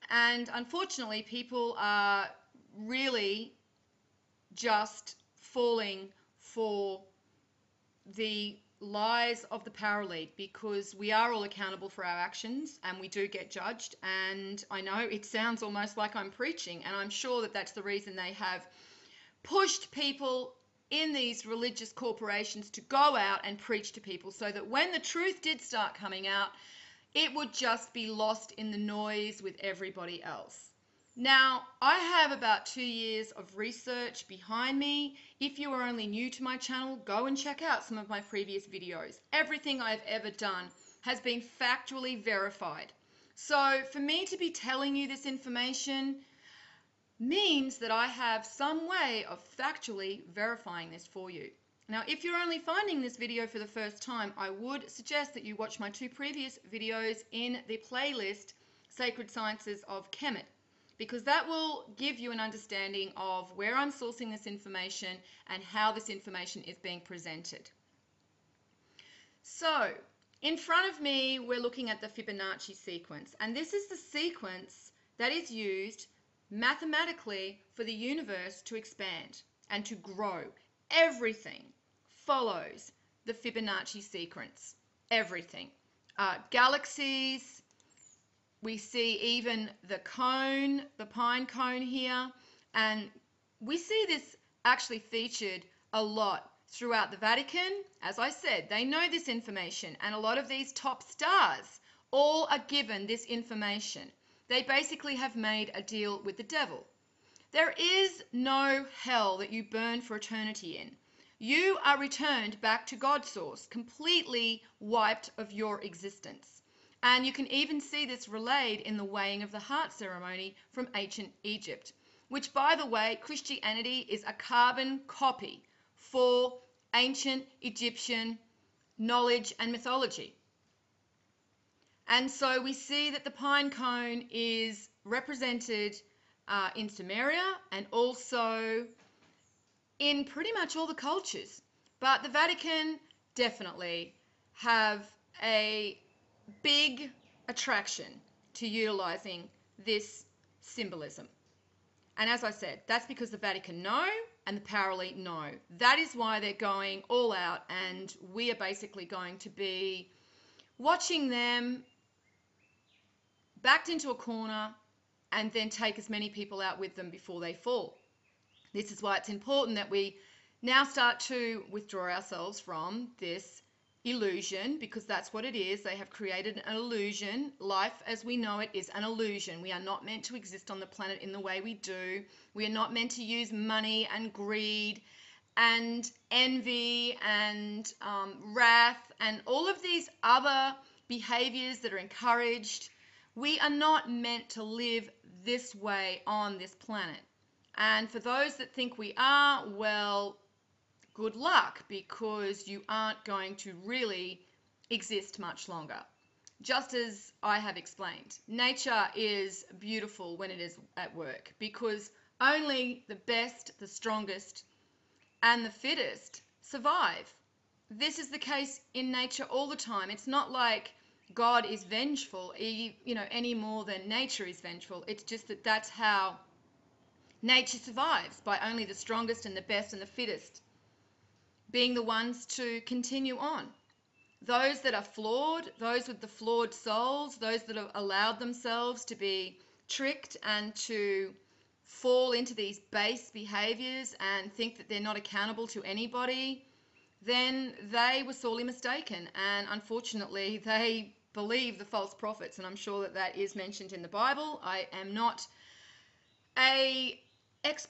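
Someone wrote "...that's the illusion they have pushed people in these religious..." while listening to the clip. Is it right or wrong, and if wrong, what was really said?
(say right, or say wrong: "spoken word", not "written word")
wrong: "reason", not "illusion".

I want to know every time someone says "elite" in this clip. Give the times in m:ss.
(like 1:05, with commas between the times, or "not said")
0:10, 2:34.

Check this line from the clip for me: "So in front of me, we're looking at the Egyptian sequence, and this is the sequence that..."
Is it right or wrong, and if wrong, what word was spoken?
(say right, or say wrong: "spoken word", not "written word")
wrong: "Fibonacci", not "Egyptian".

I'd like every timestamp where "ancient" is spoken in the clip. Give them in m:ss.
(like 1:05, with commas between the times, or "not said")
2:00, 2:06.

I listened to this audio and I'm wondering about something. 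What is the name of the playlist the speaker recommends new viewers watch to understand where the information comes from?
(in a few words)
Sacred Sciences of Kemet.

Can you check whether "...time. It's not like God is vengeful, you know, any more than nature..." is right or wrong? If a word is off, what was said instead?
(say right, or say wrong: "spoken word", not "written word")
right.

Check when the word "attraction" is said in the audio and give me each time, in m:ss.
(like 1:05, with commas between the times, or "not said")
2:27.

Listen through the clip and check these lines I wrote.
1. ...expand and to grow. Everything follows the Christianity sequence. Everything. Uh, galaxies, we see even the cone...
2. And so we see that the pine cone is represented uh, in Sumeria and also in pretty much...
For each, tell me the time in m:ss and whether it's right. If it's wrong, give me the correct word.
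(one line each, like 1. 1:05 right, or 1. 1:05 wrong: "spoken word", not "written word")
1. 1:18 wrong: "Fibonacci", not "Christianity"
2. 2:12 right.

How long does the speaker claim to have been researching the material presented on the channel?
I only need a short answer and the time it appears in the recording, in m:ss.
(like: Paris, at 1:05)
2 years, at 0:32.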